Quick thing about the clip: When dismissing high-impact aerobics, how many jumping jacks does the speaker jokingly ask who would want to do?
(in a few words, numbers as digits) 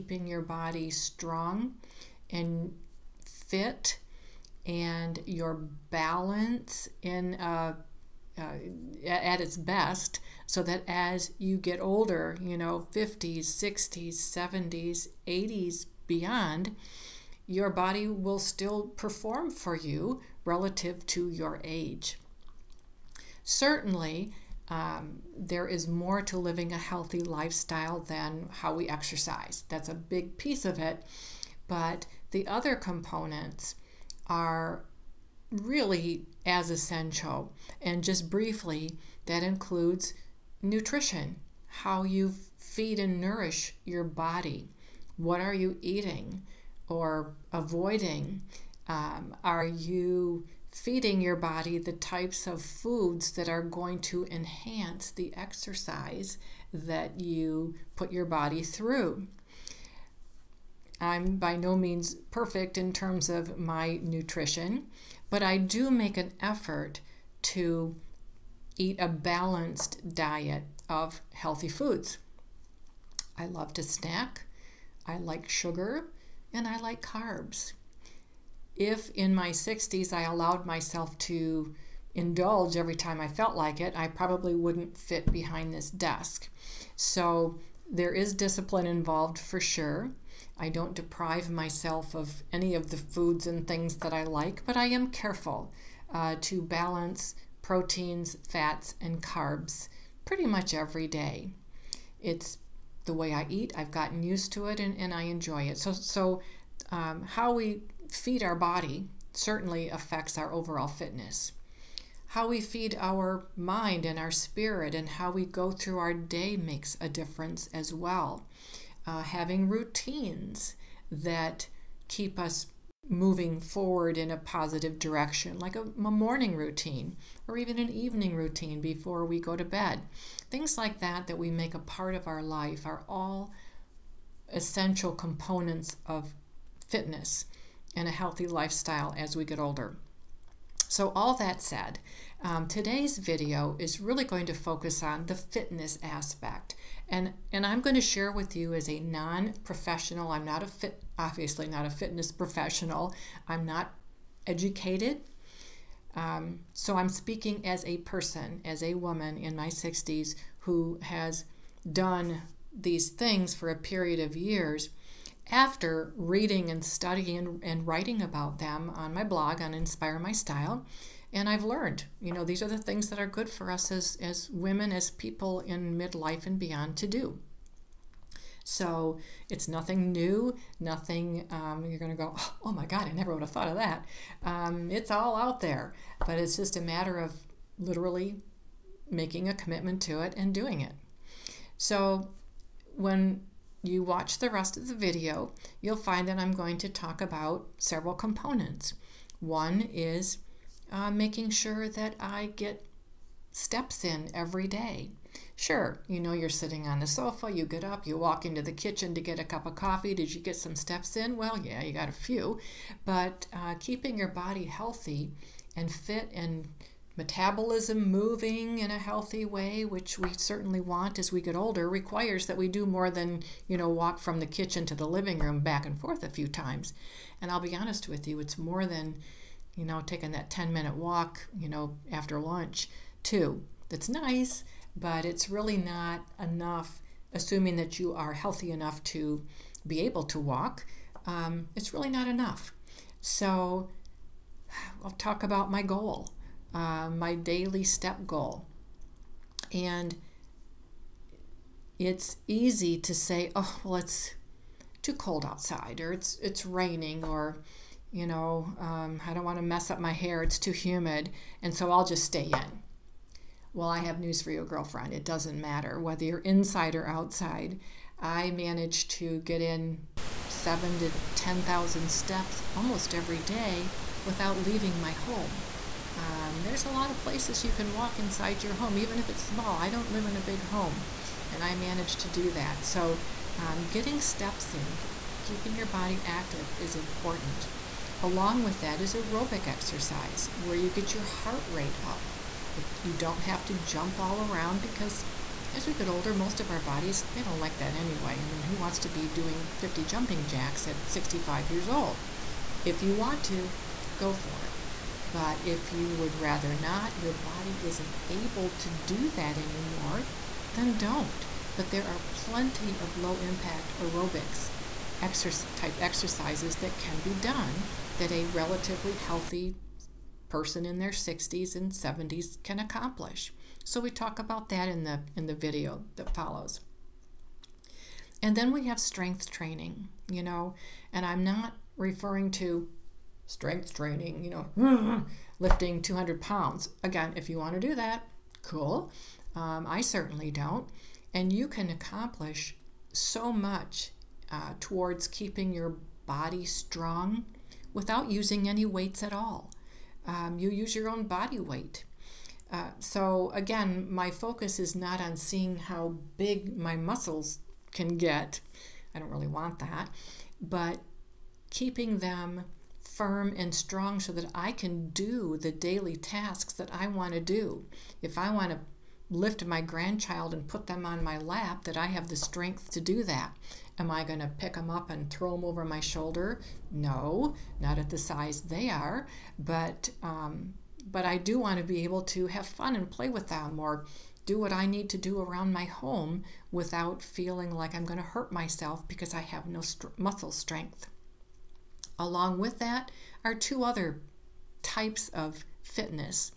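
50.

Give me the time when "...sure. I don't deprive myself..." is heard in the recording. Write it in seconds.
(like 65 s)
89 s.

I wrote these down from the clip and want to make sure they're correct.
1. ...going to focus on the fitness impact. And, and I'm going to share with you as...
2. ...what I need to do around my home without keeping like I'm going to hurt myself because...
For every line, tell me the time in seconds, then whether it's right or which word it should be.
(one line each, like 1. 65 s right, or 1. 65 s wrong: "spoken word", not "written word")
1. 144 s wrong: "aspect", not "impact"
2. 384 s wrong: "feeling", not "keeping".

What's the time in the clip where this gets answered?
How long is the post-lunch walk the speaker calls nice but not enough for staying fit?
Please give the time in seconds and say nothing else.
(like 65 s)
230 s.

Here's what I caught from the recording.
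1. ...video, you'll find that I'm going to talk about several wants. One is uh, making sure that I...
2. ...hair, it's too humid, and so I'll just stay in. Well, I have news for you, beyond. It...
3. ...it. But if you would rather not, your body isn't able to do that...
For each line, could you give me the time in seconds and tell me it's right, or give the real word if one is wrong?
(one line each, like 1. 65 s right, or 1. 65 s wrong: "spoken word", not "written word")
1. 194 s wrong: "components", not "wants"
2. 260 s wrong: "girlfriend", not "beyond"
3. 304 s right.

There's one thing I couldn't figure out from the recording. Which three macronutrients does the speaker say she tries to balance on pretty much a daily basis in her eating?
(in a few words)
proteins, fats, and carbs.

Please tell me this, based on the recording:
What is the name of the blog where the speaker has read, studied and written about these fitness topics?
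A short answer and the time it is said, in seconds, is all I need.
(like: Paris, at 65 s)
Inspire My Style, at 169 s.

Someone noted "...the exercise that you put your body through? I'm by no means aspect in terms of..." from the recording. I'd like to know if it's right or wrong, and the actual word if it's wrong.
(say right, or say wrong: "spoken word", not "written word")
wrong: "perfect", not "aspect".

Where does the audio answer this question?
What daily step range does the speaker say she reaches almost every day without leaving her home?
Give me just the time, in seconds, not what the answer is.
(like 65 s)
270 s.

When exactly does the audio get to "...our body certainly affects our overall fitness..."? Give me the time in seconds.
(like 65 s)
108 s.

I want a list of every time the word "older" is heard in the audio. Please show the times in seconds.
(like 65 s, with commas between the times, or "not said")
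11 s, 139 s, 221 s, 296 s.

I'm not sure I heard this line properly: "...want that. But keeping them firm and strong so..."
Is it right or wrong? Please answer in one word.
right.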